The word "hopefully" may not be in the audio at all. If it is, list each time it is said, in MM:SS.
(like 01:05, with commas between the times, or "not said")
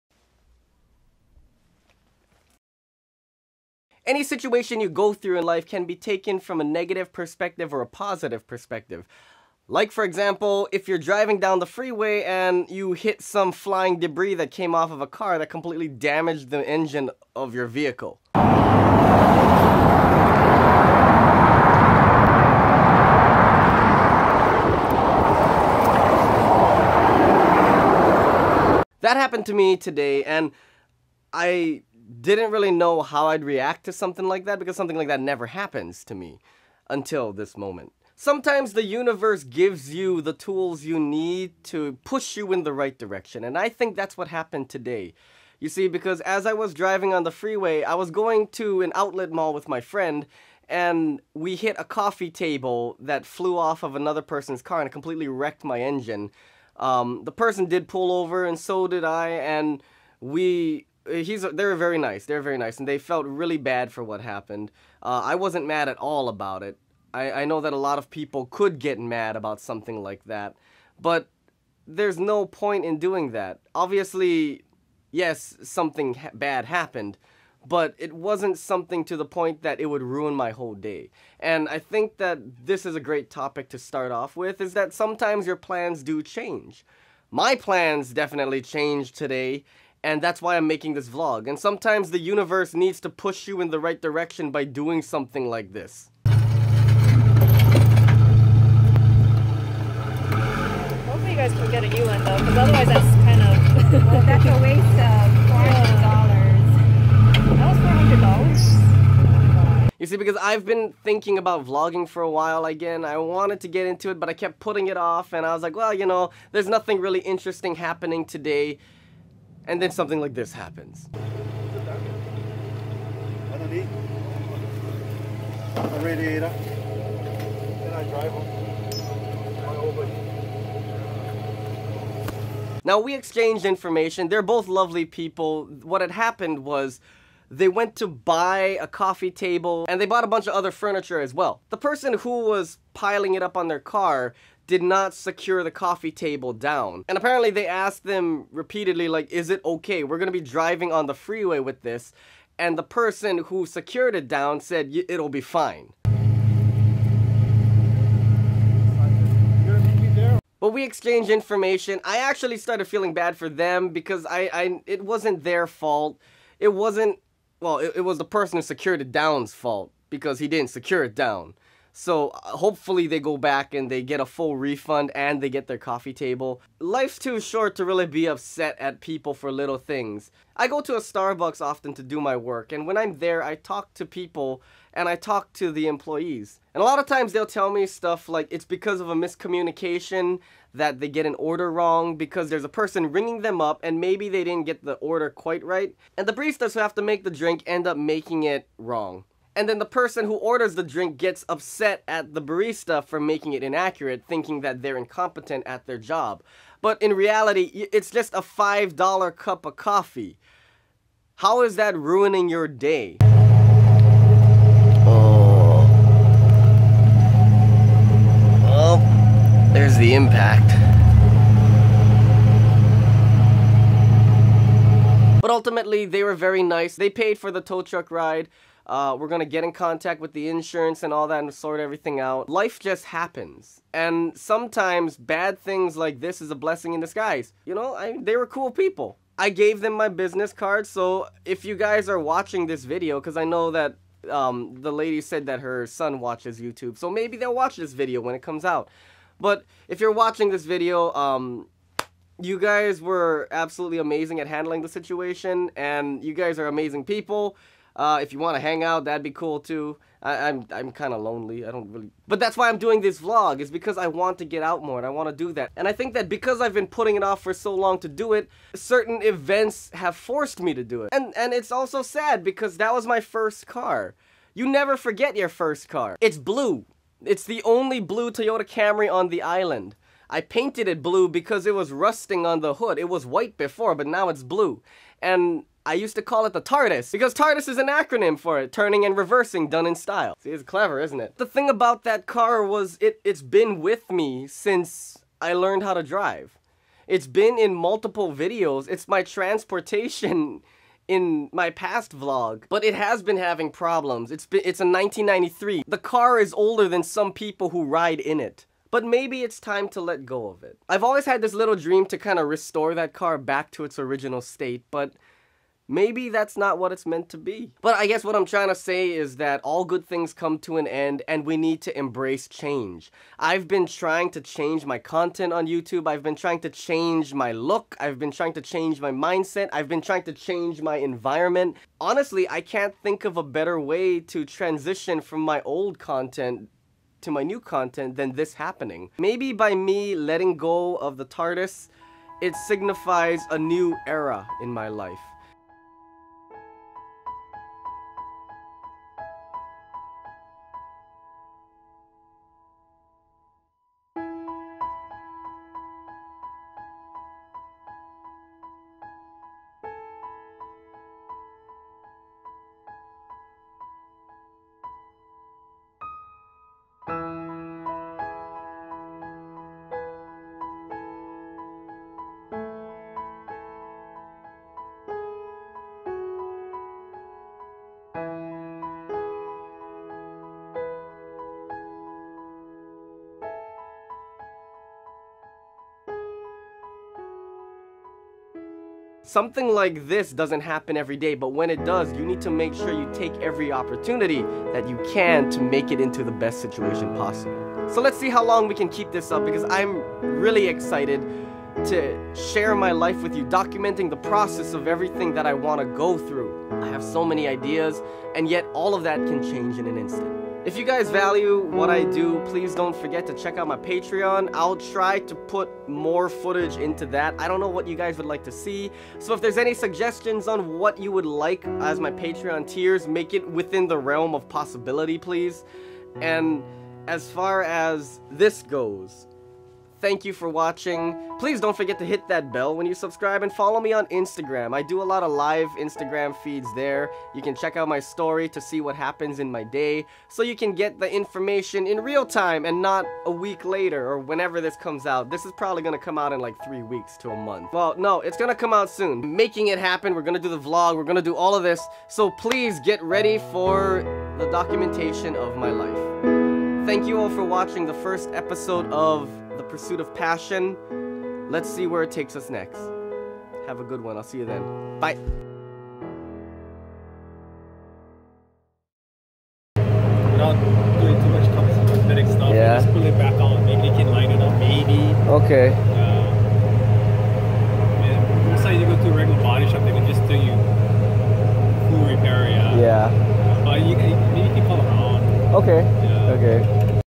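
01:41, 02:52.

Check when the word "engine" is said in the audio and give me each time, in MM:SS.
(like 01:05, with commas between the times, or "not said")
00:55.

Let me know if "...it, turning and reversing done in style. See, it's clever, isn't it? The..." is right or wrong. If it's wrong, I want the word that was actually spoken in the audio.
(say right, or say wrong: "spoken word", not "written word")
right.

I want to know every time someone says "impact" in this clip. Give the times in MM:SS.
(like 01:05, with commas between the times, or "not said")
03:40.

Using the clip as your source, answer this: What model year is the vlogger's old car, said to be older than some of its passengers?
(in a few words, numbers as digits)
1993.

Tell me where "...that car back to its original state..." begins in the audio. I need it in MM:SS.
05:12.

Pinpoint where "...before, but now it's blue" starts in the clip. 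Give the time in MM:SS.
04:43.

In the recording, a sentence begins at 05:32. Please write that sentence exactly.
Honestly, I can't think of a better way to transition from my old content to my new content than this happening.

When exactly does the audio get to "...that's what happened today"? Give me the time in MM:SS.
00:43.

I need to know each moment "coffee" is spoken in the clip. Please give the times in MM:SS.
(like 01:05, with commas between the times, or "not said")
00:51, 02:18, 02:25, 02:55, 03:29.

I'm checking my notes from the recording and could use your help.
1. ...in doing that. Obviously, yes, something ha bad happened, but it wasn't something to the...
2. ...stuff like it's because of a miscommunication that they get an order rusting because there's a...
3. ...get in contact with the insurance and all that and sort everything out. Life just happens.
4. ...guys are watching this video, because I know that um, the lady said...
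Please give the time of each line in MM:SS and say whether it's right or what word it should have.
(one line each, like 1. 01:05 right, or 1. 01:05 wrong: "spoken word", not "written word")
1. 01:12 right
2. 03:07 wrong: "wrong", not "rusting"
3. 03:49 right
4. 04:01 right.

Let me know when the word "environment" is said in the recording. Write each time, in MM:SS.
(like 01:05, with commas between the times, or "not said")
05:30.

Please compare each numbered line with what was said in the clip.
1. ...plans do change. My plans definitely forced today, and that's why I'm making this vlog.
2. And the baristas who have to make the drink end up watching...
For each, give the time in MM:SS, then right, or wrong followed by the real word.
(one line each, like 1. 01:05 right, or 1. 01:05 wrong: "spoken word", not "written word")
1. 01:25 wrong: "changed", not "forced"
2. 03:16 wrong: "making", not "watching".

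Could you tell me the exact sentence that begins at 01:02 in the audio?
They are very nice, and they felt really bad for what happened.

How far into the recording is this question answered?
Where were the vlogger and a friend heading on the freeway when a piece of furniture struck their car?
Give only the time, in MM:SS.
00:48.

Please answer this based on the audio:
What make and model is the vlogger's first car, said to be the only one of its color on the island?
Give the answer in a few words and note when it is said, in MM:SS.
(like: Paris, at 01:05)
Toyota Camry, at 04:38.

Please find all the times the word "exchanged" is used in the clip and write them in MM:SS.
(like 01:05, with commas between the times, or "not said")
02:13, 02:40.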